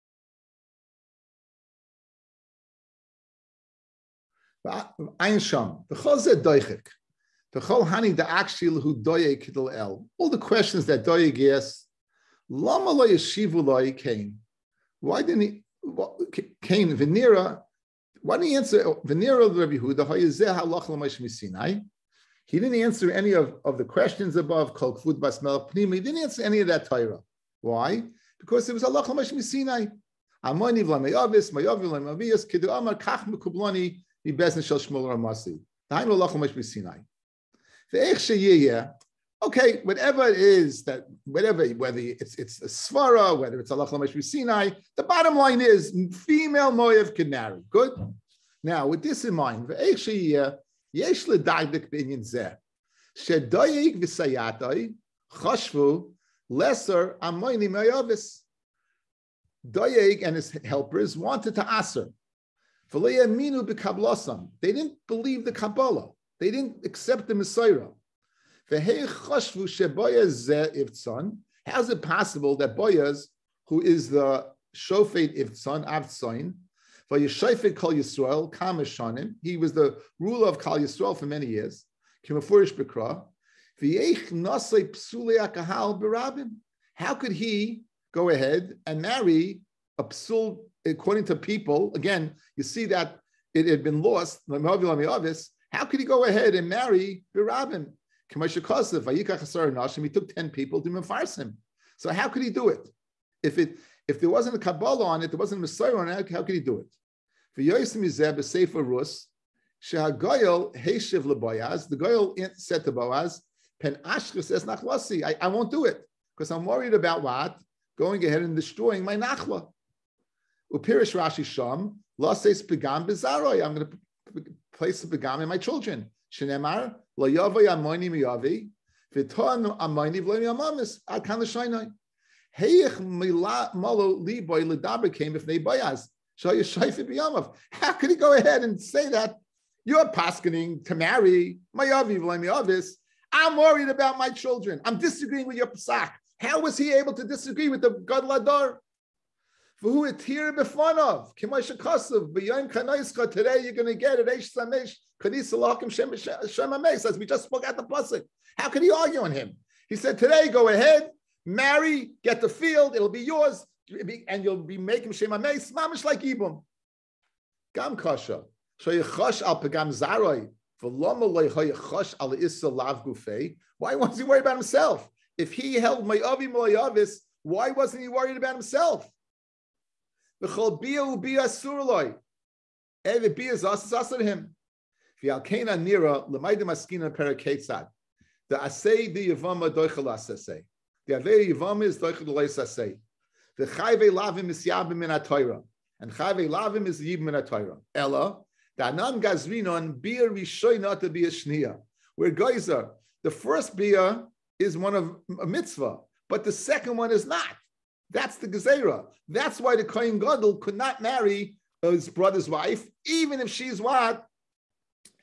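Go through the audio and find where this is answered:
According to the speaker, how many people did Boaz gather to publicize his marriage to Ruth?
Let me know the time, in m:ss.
1:40.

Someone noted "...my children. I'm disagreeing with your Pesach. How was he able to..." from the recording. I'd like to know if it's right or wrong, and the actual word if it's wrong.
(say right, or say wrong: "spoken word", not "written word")
right.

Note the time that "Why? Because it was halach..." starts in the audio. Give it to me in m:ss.
0:27.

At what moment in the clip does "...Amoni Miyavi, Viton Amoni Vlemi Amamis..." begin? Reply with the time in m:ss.
2:07.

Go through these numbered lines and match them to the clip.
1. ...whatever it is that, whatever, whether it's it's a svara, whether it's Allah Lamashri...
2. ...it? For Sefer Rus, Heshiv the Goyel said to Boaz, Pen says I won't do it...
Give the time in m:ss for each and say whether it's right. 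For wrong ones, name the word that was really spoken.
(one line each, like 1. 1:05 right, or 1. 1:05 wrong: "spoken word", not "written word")
1. 0:39 right
2. 1:46 right.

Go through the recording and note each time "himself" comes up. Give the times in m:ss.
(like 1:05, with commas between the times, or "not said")
2:54, 2:58.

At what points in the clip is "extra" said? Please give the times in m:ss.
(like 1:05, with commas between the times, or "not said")
not said.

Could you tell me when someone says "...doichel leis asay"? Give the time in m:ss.
3:11.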